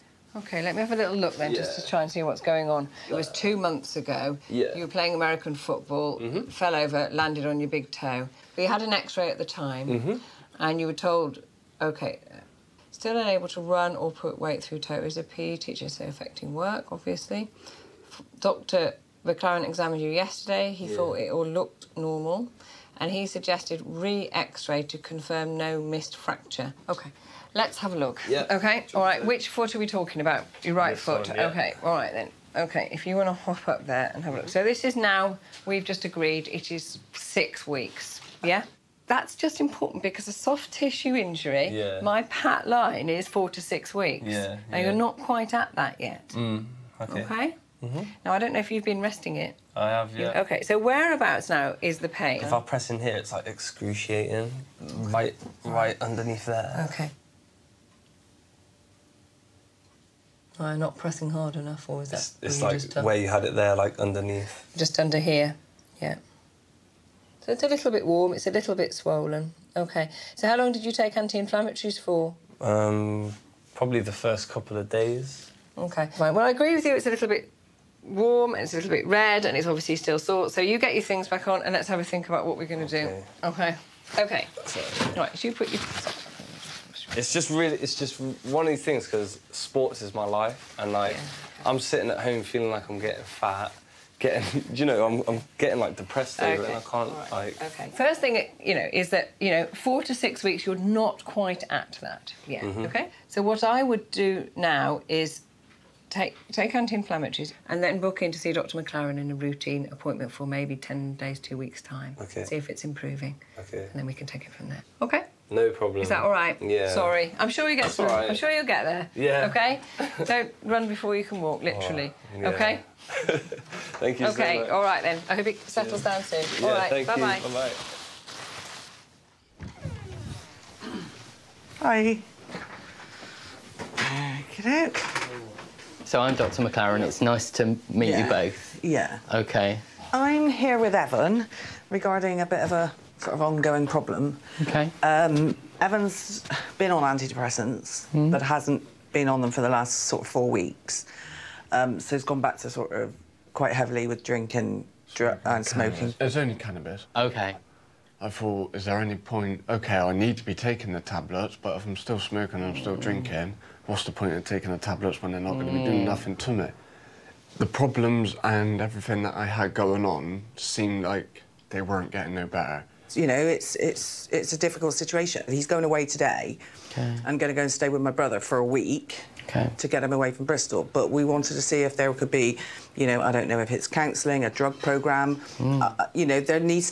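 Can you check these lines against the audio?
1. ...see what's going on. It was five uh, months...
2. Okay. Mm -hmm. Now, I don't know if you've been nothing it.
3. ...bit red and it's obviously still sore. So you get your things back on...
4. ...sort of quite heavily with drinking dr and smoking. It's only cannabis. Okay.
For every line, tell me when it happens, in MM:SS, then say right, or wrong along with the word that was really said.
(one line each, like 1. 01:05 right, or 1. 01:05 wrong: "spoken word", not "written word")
1. 00:02 wrong: "two", not "five"
2. 00:47 wrong: "resting", not "nothing"
3. 01:18 right
4. 02:32 right.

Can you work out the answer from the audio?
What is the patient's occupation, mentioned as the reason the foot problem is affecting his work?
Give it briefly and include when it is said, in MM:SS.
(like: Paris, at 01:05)
PE teacher, at 00:15.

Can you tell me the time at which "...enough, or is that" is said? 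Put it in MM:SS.
01:01.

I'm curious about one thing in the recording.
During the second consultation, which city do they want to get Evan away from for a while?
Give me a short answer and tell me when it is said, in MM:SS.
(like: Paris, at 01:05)
Bristol, at 03:00.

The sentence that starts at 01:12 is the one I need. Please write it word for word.
Um, probably the first couple of days.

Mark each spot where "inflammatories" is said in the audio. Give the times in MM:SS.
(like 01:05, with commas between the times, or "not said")
01:11, 01:46.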